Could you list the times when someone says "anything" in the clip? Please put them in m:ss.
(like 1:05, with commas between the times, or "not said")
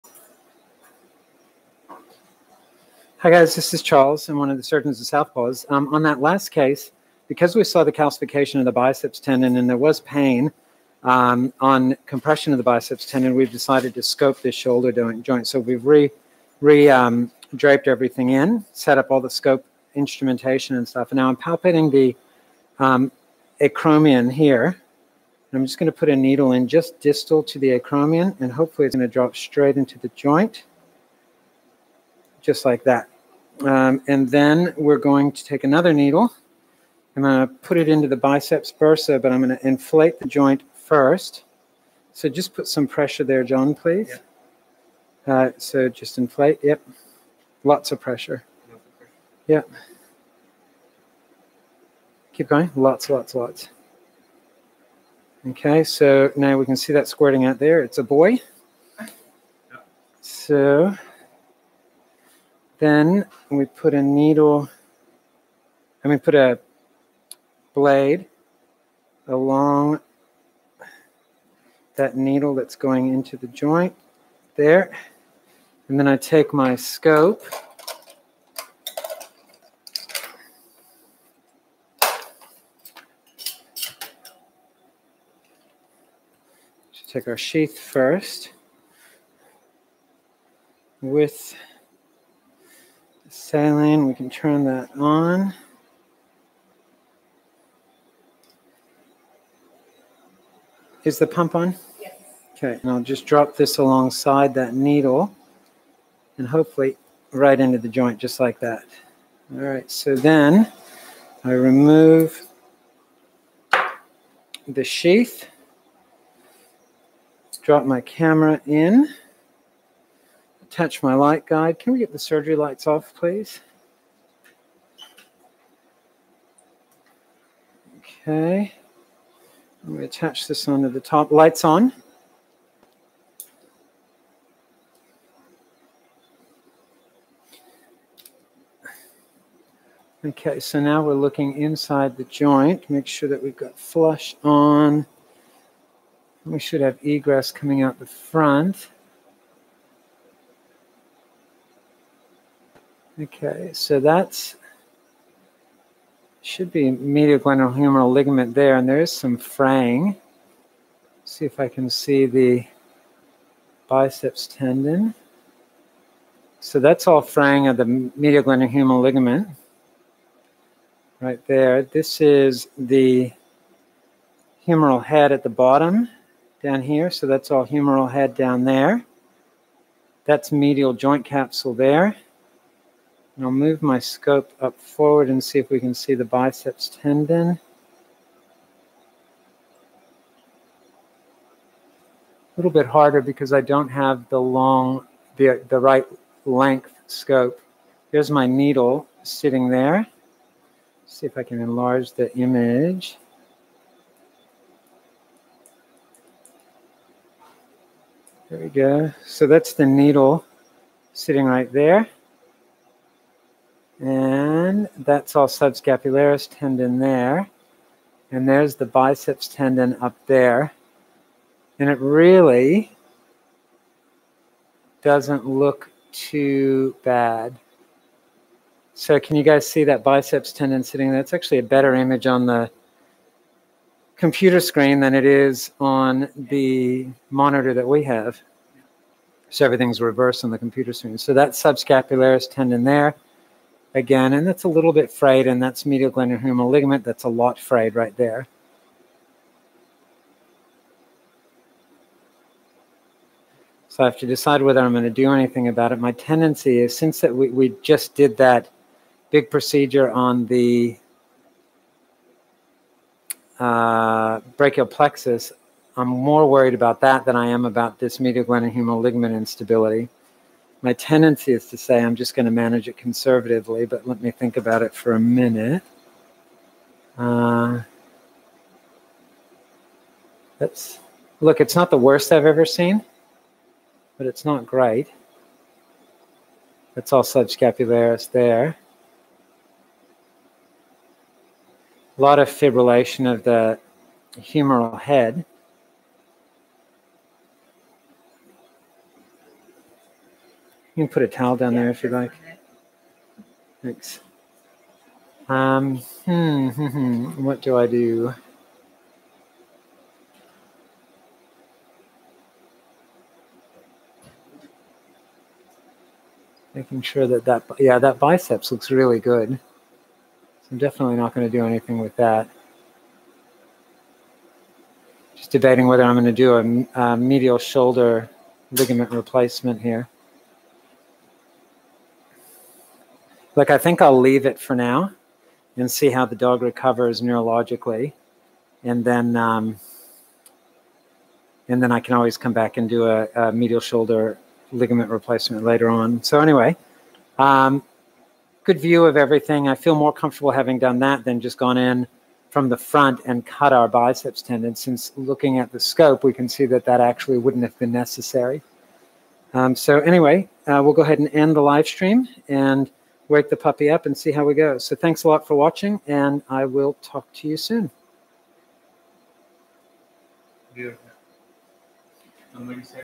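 4:15, 5:21.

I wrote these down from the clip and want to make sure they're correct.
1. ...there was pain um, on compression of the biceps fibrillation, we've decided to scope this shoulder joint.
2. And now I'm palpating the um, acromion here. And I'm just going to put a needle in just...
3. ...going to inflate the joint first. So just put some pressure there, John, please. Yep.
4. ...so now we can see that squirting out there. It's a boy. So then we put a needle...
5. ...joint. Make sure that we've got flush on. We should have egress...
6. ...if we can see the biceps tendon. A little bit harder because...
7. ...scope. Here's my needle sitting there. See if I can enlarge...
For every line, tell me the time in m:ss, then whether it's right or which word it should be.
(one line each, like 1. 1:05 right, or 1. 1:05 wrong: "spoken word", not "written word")
1. 0:09 wrong: "tendon", not "fibrillation"
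2. 0:21 right
3. 0:39 right
4. 0:55 right
5. 2:22 right
6. 3:05 right
7. 3:17 right.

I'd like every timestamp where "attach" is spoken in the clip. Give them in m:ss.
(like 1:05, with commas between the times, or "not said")
2:10.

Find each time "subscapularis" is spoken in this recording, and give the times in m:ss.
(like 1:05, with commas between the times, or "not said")
3:35, 4:01, 4:47.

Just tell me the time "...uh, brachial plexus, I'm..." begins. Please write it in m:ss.
4:23.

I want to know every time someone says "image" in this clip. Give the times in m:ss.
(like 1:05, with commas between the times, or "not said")
3:22, 3:51.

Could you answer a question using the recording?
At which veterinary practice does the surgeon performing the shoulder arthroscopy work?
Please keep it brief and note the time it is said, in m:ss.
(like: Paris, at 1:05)
Southpaws, at 0:05.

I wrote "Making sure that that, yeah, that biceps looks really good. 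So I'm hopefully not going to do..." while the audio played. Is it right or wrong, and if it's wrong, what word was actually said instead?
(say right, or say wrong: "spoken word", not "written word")
wrong: "definitely", not "hopefully".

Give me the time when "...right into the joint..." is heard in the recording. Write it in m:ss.
1:47.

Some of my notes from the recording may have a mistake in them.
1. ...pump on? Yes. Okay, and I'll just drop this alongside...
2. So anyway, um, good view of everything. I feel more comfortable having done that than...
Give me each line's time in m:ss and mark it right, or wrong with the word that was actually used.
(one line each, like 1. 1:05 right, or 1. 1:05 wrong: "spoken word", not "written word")
1. 1:41 right
2. 5:46 right.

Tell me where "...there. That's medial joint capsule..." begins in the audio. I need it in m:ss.
2:58.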